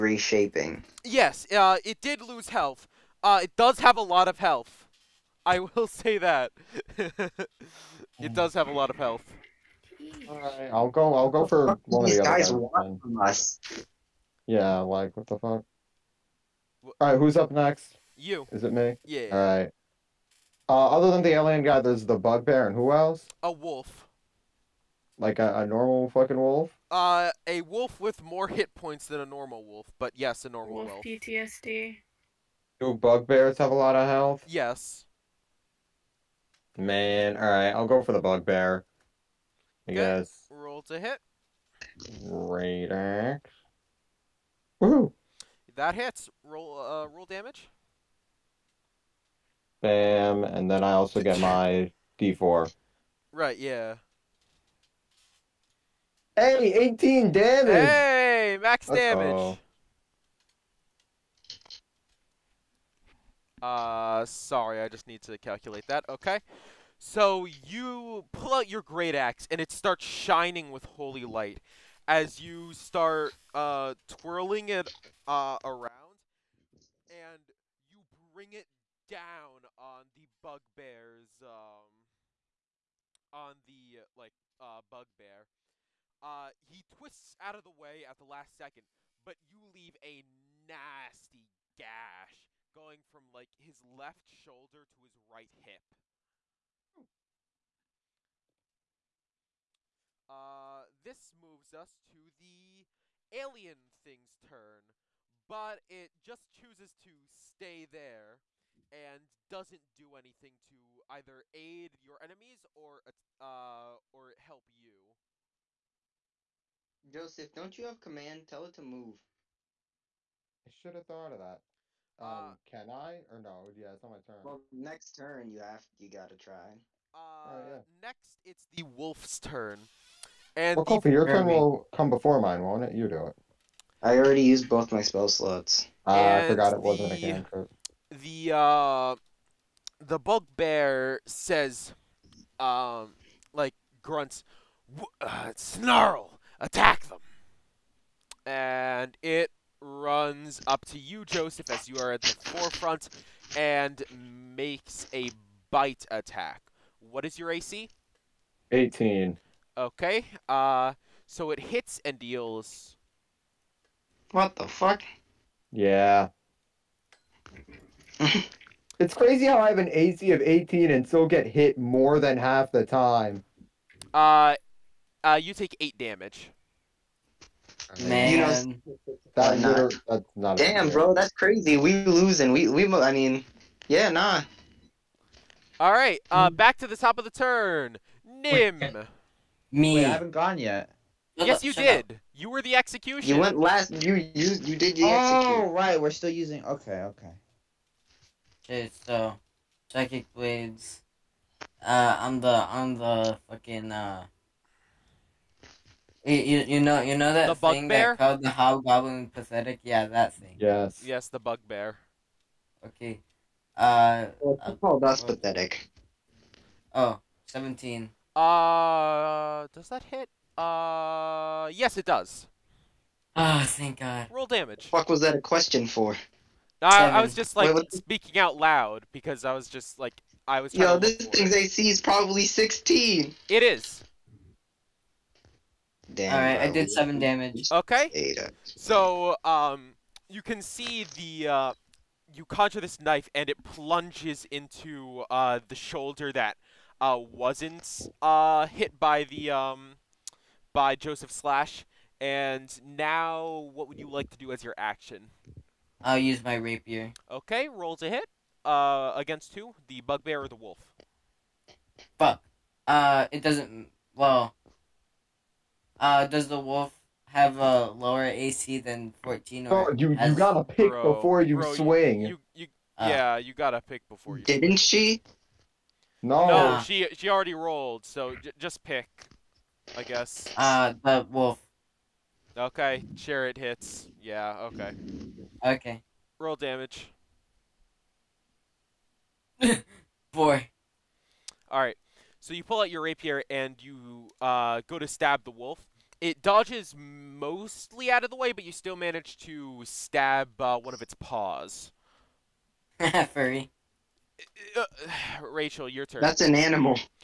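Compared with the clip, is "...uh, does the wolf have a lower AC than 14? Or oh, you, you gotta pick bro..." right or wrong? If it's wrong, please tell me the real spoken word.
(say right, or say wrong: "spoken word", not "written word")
right.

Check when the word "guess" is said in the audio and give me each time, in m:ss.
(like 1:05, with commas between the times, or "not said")
0:39, 4:40.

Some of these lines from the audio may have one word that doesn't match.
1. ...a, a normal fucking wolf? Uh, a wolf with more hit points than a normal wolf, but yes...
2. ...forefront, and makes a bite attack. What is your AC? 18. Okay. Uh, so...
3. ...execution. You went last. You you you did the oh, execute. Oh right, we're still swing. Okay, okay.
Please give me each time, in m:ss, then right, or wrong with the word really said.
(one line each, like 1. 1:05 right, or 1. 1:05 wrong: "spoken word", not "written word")
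1. 0:25 right
2. 2:32 right
3. 3:12 wrong: "using", not "swing".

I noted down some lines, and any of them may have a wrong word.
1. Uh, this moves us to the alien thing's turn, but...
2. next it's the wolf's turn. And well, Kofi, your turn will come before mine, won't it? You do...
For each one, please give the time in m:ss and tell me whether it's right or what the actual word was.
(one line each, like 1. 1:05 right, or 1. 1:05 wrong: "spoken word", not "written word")
1. 1:40 right
2. 2:07 right.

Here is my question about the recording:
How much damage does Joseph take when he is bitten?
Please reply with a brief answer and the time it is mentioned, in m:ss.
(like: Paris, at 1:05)
8, at 2:55.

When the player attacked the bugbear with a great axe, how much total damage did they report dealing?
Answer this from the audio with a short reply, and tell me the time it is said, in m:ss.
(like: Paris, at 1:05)
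18, at 0:56.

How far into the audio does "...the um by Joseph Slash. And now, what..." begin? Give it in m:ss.
4:09.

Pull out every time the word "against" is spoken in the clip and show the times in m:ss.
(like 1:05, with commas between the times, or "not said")
4:19.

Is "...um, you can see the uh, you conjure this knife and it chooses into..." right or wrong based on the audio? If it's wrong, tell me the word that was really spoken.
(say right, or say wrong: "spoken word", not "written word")
wrong: "plunges", not "chooses".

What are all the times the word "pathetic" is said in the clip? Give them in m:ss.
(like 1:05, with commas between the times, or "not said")
3:29, 3:35.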